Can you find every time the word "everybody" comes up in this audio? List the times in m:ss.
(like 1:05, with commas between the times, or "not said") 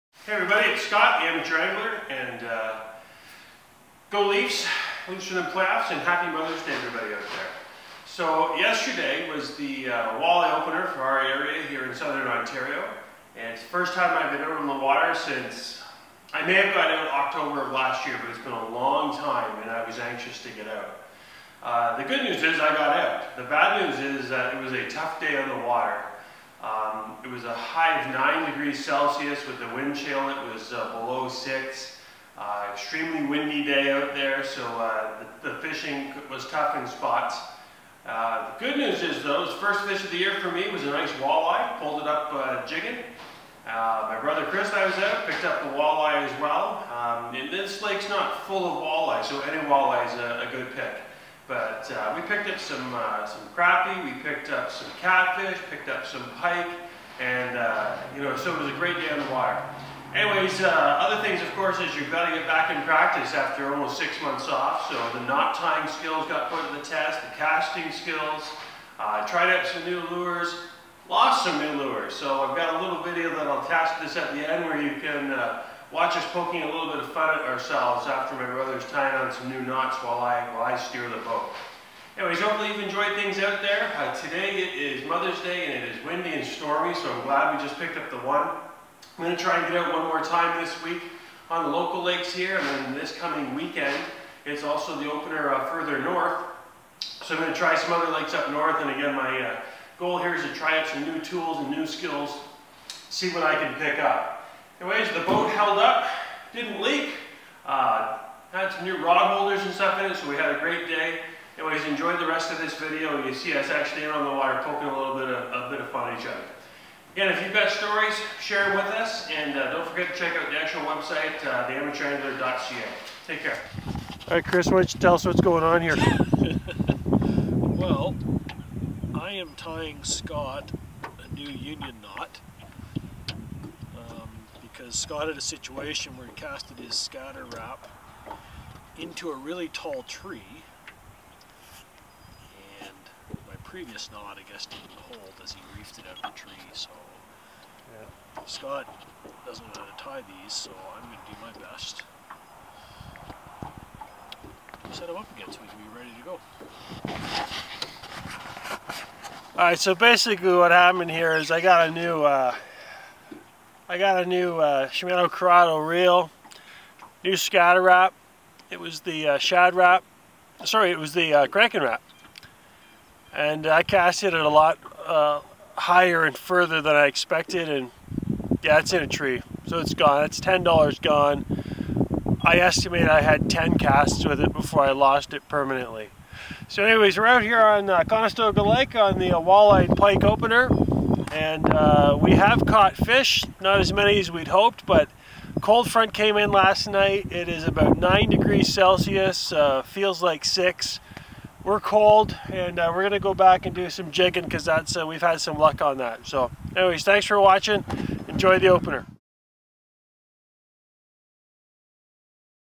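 0:00, 0:06.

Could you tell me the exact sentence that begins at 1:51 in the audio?
Anyways, enjoyed the rest of this video.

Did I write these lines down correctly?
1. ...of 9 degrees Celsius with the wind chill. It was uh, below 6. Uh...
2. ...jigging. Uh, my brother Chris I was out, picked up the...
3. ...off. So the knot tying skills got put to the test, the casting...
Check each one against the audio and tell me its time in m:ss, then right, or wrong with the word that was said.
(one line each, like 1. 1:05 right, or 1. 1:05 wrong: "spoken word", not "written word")
1. 0:28 right
2. 0:42 right
3. 1:04 right.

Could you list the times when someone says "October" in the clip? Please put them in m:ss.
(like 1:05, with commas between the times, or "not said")
0:17.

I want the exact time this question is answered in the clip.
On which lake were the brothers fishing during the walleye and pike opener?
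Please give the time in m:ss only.
3:08.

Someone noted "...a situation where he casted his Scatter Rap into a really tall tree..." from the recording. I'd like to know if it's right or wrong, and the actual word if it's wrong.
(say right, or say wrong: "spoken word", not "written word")
right.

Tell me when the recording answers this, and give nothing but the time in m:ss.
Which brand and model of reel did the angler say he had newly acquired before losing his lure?
2:44.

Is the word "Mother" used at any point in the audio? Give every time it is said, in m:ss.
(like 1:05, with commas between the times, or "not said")
0:06, 1:25.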